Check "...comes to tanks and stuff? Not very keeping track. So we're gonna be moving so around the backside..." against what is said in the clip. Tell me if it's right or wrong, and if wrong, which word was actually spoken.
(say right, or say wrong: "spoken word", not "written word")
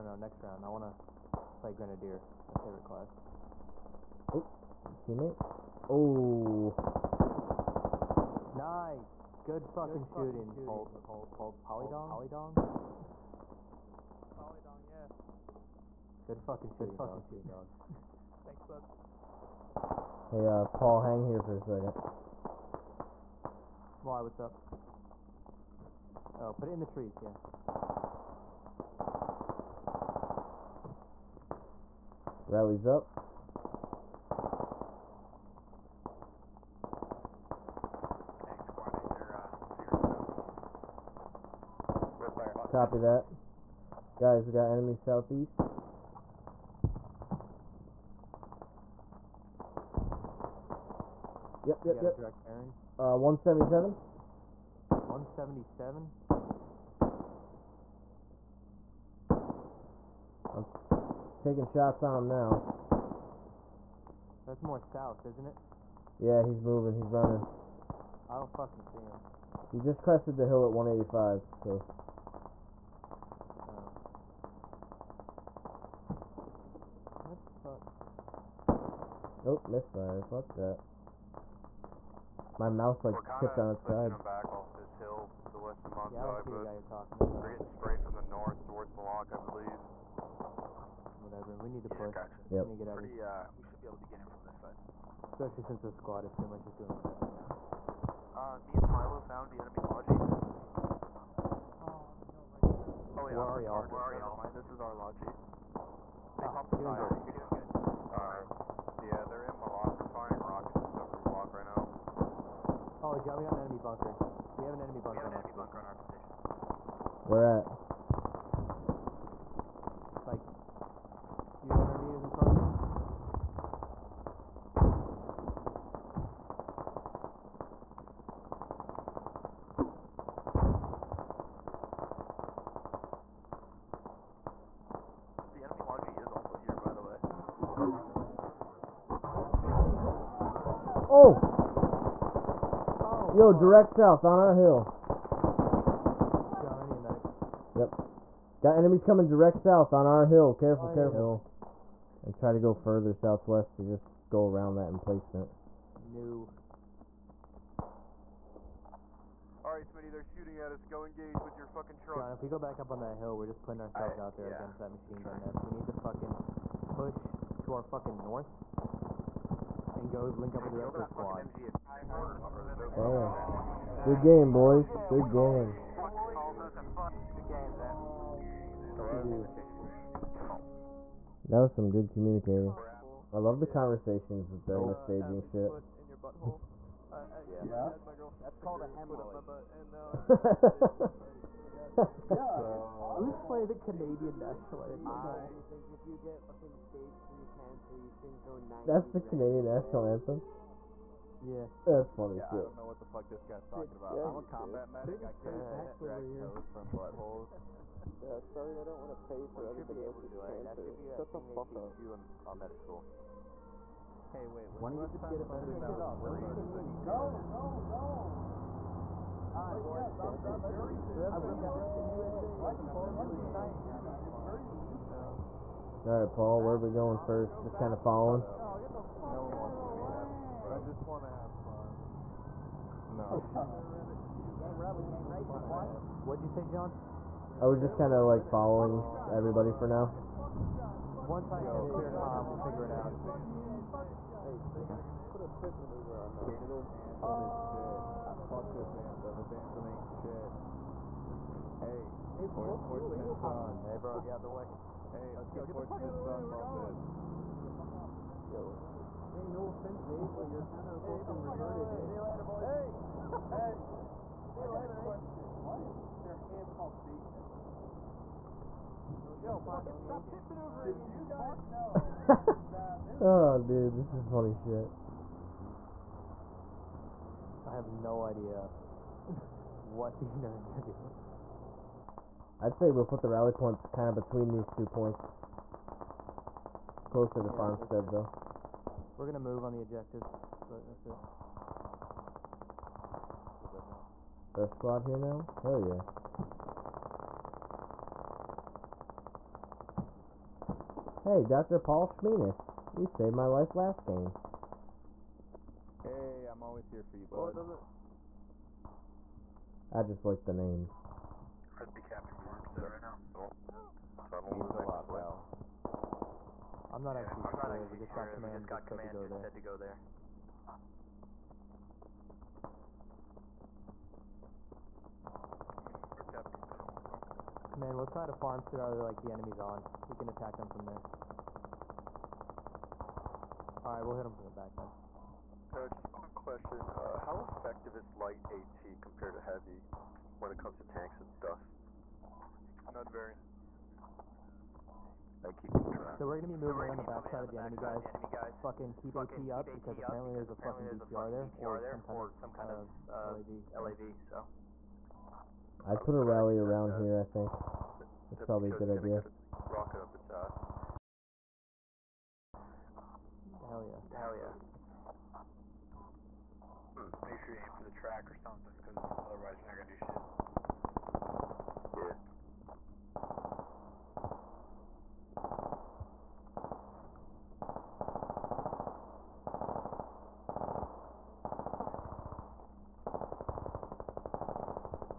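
right.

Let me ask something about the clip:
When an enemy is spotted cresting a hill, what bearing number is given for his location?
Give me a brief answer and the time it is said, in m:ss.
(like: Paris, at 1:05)
185, at 1:10.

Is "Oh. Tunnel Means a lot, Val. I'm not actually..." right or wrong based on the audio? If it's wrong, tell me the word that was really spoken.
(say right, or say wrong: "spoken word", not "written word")
right.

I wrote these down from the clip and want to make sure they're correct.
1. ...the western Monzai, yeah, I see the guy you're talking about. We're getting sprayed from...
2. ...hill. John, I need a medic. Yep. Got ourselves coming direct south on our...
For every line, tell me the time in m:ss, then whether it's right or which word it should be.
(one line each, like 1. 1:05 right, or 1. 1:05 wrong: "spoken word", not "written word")
1. 1:25 right
2. 2:24 wrong: "enemies", not "ourselves".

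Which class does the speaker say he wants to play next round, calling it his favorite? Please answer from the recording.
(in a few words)
Grenadier.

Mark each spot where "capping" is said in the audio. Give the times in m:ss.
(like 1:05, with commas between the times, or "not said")
5:12.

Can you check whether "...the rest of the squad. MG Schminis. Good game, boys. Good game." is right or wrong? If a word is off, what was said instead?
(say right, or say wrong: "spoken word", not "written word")
wrong: "Damn", not "Schminis".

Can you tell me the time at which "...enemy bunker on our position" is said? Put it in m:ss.
1:55.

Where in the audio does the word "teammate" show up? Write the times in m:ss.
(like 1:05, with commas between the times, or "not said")
0:05.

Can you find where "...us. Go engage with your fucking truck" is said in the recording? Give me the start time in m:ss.
2:40.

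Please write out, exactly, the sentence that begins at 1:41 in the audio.
Oh, right oh yeah, where are y'all?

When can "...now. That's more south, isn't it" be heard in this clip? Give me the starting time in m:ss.
1:02.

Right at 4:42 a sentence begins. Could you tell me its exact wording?
I'd say we'll put the rally point kind of between these two points.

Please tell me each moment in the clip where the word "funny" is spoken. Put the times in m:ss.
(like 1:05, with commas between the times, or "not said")
3:22, 4:34.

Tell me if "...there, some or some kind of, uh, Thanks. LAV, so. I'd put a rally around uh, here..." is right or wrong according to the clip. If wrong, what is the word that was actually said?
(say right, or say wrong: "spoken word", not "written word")
wrong: "LAV", not "Thanks".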